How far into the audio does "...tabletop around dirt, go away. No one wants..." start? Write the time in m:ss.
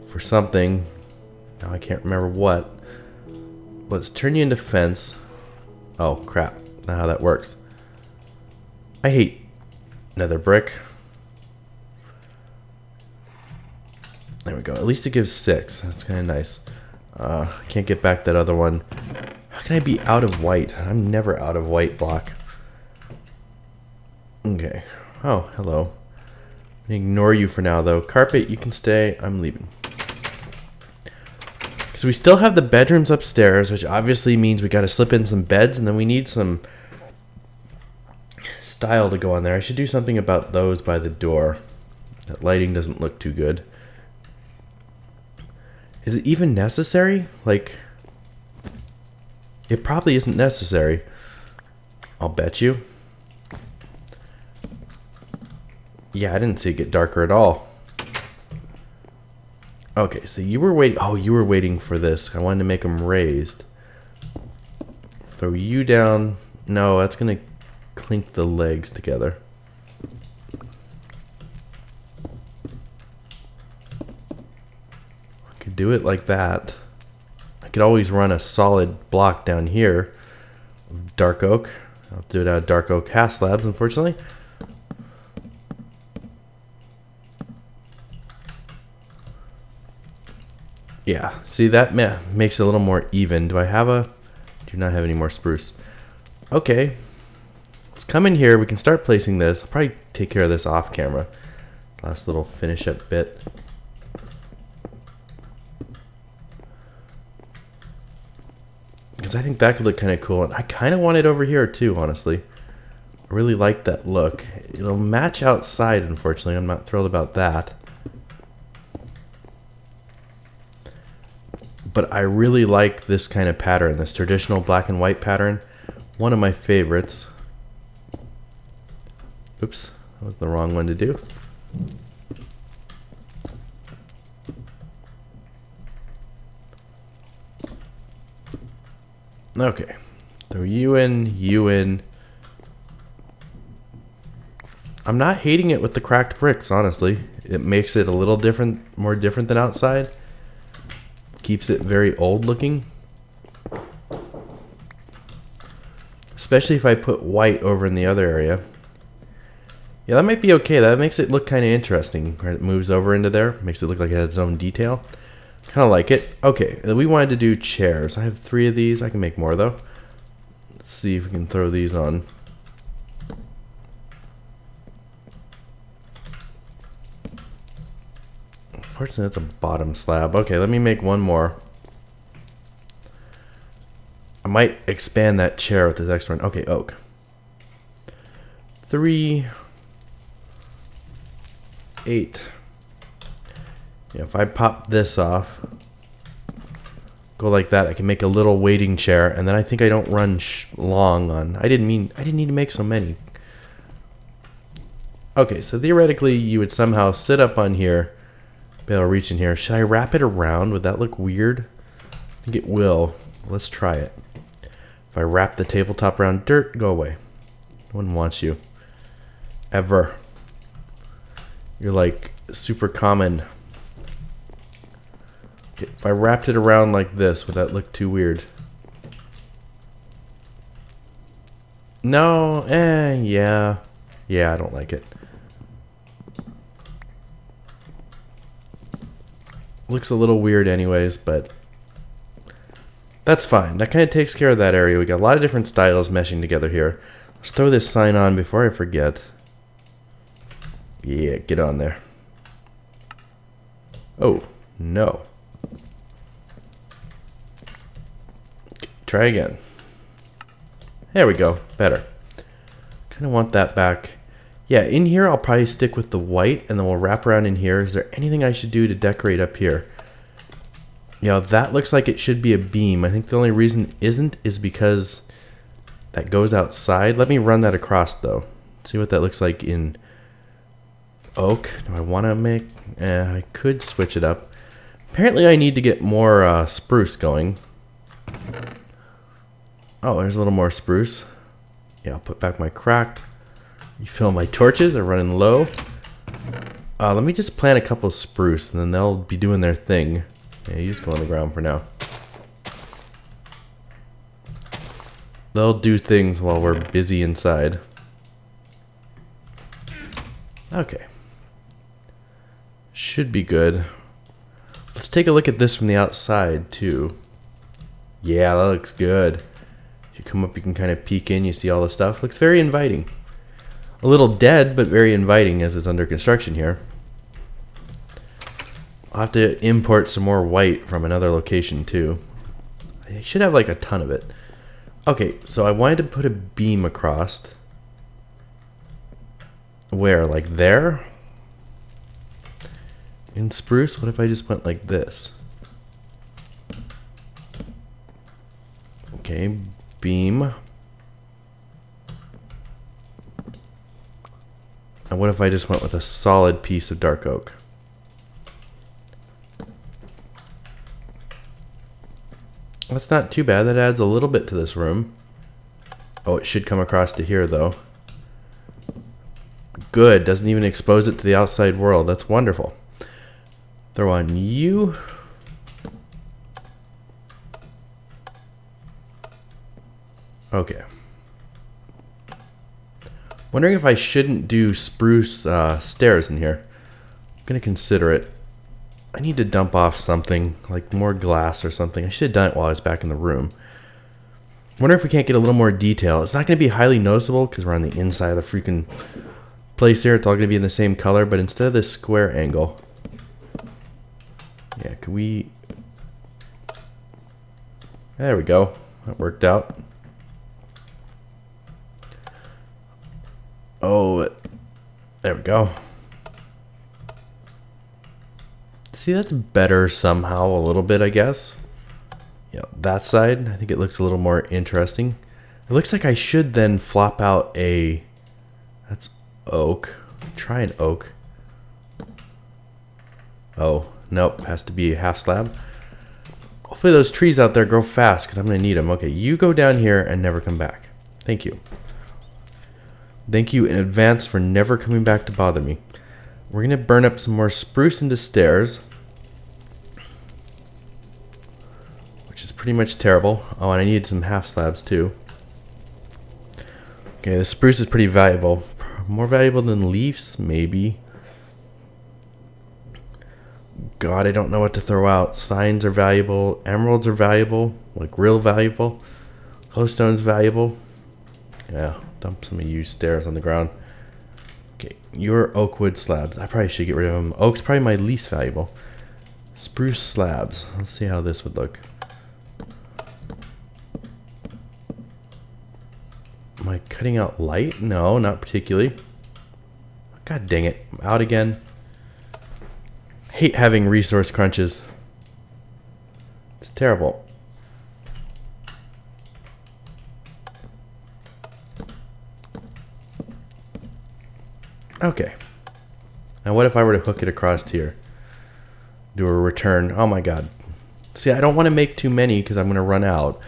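3:35.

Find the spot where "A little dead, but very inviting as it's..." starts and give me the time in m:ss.
5:24.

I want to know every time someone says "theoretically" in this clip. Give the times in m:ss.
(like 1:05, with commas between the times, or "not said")
3:25.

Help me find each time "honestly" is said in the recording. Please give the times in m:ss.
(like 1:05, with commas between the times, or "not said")
1:51, 2:26.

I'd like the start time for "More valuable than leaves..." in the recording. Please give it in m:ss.
7:39.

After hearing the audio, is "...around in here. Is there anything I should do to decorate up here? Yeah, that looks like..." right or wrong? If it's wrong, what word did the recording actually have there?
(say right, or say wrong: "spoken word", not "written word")
right.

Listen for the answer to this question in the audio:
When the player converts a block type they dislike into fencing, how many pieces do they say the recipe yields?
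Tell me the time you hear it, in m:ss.
0:15.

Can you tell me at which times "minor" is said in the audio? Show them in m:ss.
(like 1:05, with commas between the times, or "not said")
not said.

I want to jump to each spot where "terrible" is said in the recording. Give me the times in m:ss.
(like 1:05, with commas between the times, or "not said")
7:32, 8:16.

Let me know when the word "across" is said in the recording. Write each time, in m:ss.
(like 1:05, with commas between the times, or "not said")
4:37, 5:36, 6:06, 8:27.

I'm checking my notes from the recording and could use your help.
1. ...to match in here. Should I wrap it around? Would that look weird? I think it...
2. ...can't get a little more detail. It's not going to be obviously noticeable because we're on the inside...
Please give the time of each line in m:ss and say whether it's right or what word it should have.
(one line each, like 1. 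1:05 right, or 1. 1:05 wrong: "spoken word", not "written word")
1. 3:29 wrong: "reach", not "match"
2. 6:35 wrong: "highly", not "obviously".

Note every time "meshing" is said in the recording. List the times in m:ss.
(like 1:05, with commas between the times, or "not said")
4:06.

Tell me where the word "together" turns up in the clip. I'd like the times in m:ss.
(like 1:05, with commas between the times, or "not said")
1:08, 4:06.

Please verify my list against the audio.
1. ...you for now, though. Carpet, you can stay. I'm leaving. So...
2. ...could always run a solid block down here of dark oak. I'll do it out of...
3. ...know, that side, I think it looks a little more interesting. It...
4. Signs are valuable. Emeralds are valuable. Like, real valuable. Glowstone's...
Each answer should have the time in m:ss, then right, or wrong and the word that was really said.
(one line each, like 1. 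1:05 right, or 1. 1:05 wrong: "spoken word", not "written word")
1. 0:27 right
2. 1:17 right
3. 7:02 right
4. 7:45 right.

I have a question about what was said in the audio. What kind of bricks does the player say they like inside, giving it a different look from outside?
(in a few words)
cracked bricks.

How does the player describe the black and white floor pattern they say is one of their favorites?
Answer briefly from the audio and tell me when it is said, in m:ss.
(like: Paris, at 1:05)
traditional, at 2:04.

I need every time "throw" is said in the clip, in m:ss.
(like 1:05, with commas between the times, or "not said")
1:05, 2:51, 4:07, 6:13, 7:44.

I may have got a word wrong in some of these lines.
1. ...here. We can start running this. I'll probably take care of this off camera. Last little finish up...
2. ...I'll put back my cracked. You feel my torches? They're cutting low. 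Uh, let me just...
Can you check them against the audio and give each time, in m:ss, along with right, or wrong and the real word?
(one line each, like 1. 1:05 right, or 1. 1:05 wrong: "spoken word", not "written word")
1. 1:38 wrong: "placing", not "running"
2. 4:52 wrong: "running", not "cutting".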